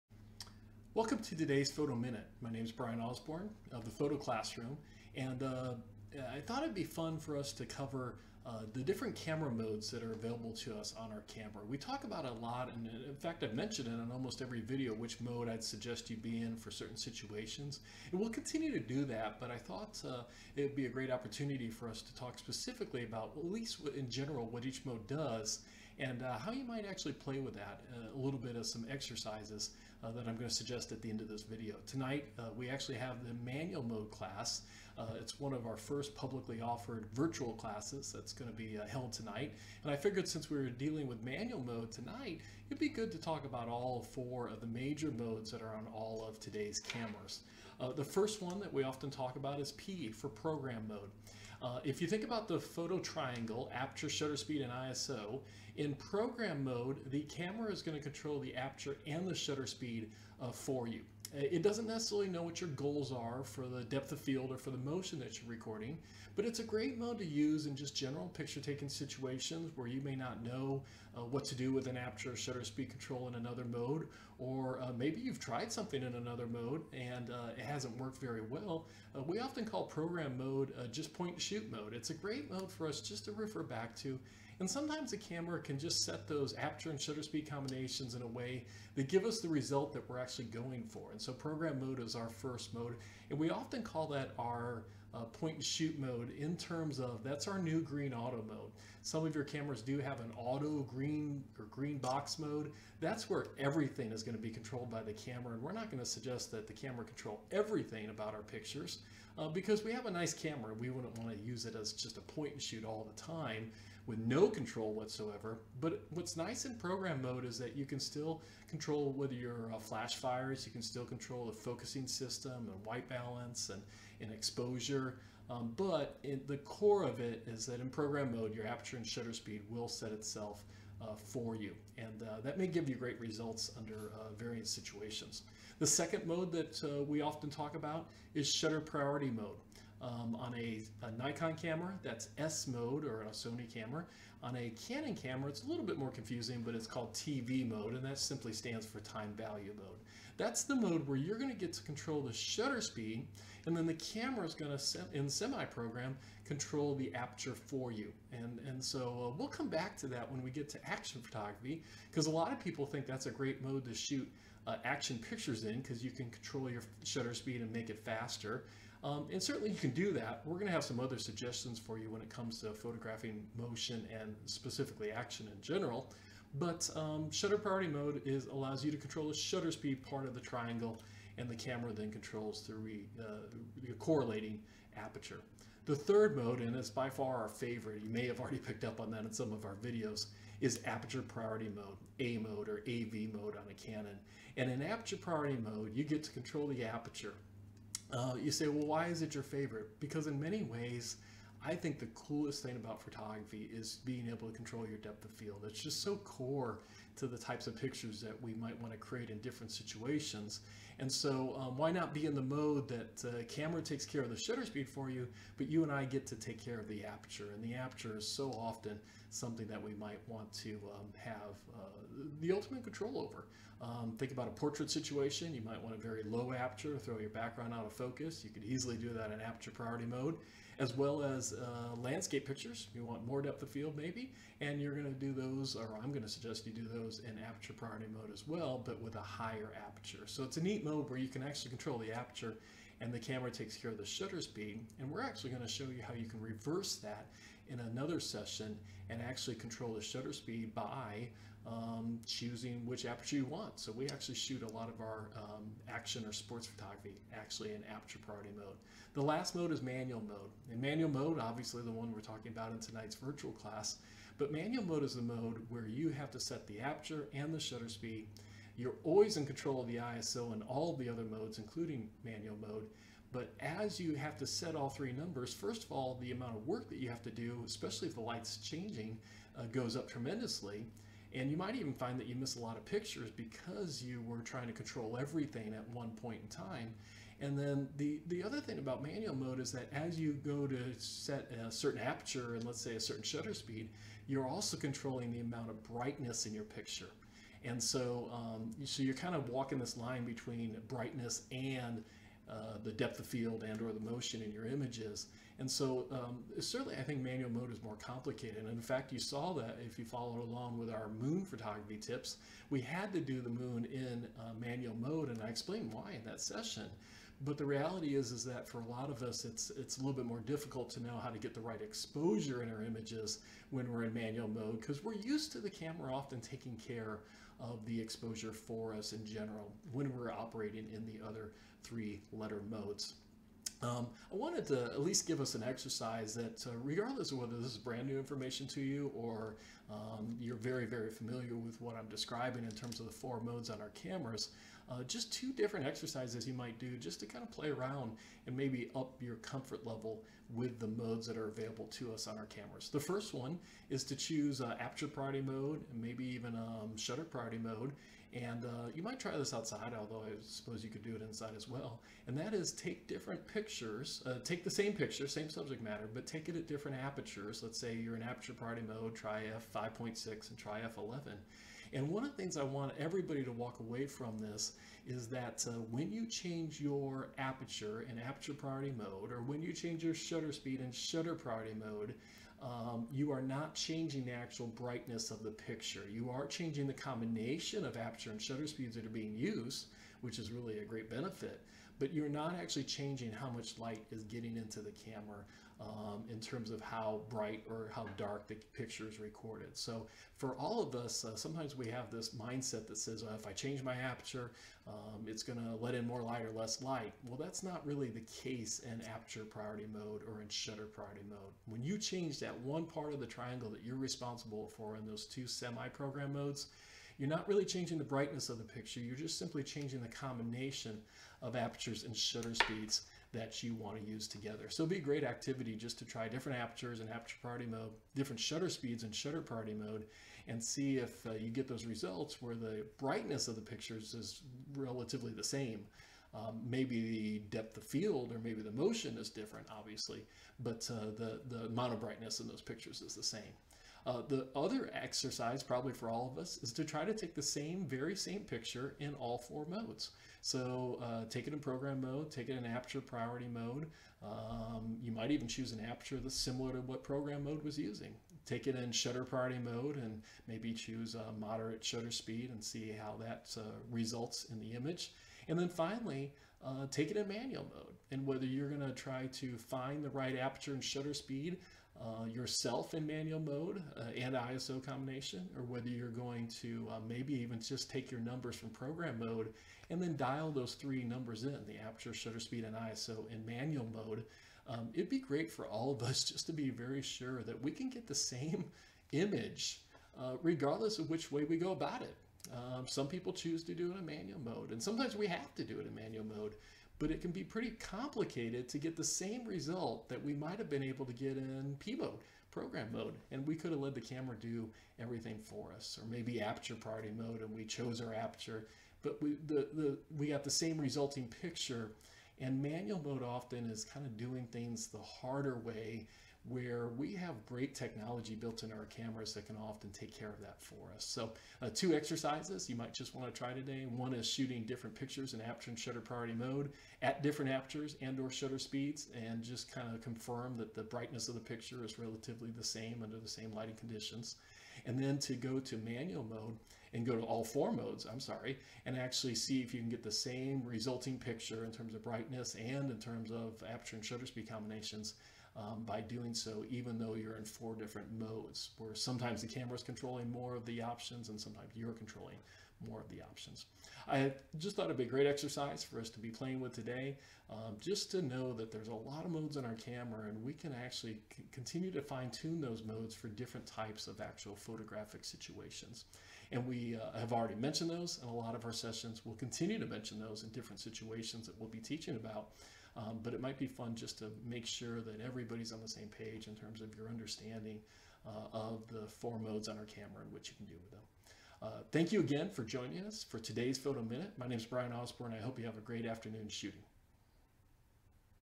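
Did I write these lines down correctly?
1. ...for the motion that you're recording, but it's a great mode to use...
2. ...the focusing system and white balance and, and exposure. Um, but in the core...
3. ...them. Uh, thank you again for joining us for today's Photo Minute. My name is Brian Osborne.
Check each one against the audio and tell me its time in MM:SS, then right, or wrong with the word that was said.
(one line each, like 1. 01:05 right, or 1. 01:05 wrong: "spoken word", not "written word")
1. 01:04 right
2. 02:01 right
3. 09:40 right.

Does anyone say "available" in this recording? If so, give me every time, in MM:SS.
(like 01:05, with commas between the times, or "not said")
00:10, 05:51.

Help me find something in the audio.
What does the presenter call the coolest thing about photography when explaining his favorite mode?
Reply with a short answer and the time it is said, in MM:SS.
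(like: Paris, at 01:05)
control your depth of field, at 03:24.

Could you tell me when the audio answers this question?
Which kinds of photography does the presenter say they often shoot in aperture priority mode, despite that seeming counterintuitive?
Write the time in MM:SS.
04:15.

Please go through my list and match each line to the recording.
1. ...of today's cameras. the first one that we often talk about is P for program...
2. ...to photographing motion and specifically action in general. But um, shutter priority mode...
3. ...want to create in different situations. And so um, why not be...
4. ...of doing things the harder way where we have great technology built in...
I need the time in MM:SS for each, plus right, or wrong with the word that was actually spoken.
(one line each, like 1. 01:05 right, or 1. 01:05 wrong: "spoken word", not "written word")
1. 00:46 right
2. 02:52 right
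3. 03:28 right
4. 08:34 right.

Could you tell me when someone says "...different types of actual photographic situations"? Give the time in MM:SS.
09:23.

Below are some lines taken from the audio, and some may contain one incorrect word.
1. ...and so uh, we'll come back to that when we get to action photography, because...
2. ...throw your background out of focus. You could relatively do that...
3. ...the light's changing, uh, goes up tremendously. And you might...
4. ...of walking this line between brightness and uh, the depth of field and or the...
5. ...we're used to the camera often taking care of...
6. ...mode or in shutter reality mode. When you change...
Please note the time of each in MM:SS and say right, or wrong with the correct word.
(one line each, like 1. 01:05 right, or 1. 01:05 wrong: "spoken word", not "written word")
1. 02:38 right
2. 03:46 wrong: "easily", not "relatively"
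3. 04:38 right
4. 04:59 right
5. 05:25 right
6. 06:49 wrong: "priority", not "reality".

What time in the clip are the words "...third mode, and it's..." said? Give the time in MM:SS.
03:05.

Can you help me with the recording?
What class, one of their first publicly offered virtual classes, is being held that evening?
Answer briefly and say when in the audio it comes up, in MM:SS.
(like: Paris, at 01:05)
manual mode class, at 00:33.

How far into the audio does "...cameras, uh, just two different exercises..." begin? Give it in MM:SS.
05:43.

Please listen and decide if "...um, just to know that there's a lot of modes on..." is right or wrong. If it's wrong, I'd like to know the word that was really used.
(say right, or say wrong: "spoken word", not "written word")
right.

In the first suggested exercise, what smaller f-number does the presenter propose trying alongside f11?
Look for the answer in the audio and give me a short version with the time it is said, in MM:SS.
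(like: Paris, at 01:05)
f5.6, at 06:09.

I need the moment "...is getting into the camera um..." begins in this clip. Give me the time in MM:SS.
06:34.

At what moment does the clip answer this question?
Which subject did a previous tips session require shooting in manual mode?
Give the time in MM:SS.
05:13.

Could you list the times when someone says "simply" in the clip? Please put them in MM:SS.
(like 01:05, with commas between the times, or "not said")
02:28, 06:59.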